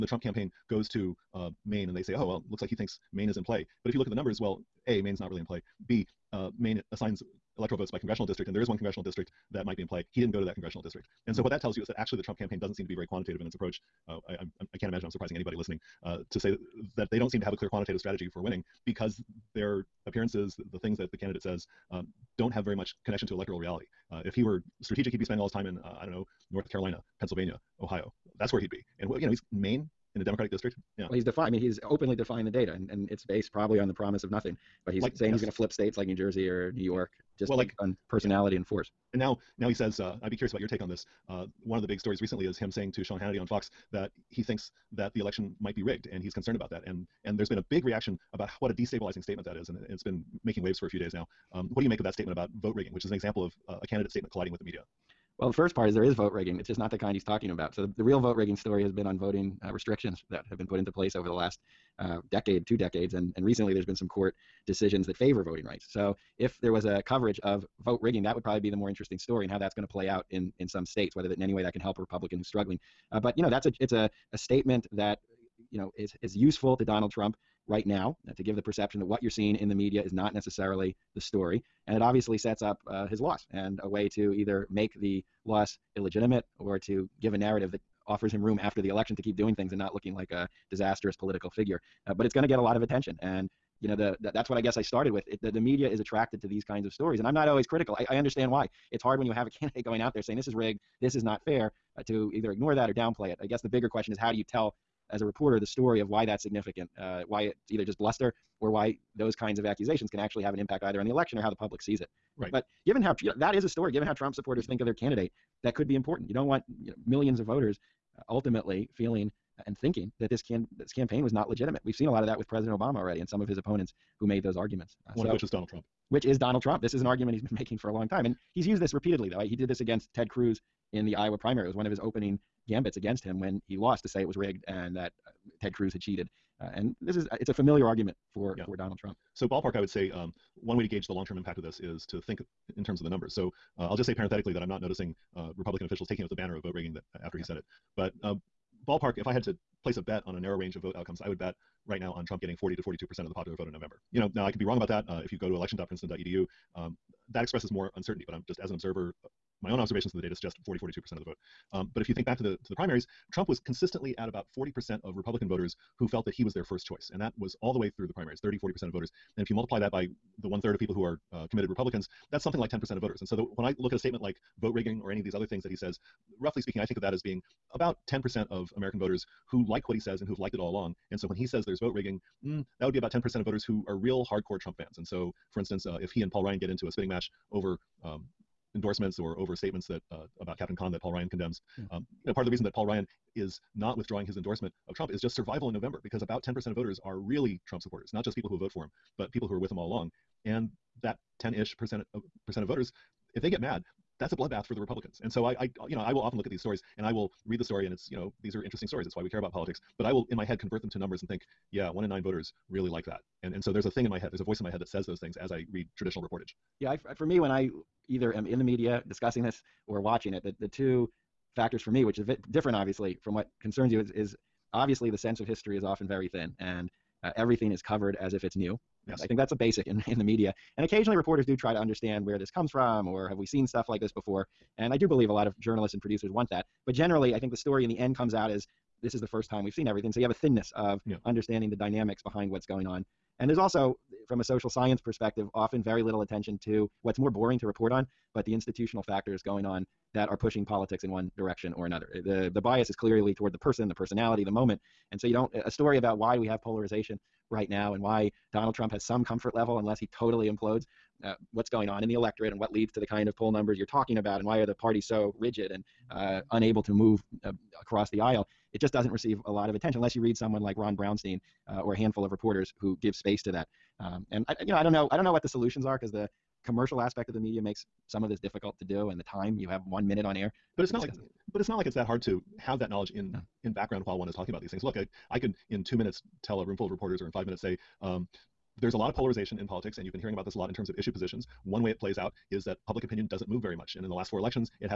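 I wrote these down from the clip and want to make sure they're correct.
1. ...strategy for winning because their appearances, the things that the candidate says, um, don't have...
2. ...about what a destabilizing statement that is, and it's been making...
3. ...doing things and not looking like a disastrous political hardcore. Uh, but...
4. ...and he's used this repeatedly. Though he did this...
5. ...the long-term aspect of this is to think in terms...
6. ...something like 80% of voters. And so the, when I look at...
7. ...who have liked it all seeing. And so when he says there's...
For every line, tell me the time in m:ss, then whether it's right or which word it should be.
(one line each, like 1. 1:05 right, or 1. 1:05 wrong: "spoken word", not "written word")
1. 0:17 right
2. 0:48 right
3. 1:29 wrong: "figure", not "hardcore"
4. 2:08 right
5. 2:21 wrong: "impact", not "aspect"
6. 2:52 wrong: "10", not "80"
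7. 3:00 wrong: "along", not "seeing".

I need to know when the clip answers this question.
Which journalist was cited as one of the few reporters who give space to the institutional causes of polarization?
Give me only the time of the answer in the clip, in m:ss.
4:30.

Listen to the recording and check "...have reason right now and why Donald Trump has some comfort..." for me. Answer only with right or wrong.
wrong.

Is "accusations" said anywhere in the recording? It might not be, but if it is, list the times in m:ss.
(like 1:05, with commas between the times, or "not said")
1:49.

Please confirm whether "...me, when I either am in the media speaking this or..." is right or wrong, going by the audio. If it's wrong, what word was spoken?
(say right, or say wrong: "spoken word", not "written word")
wrong: "discussing", not "speaking".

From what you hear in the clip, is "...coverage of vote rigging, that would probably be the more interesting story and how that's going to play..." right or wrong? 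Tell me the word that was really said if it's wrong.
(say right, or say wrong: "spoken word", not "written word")
right.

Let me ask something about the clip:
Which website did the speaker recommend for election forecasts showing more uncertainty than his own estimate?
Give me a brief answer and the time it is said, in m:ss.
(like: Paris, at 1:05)
election.princeton.edu, at 2:35.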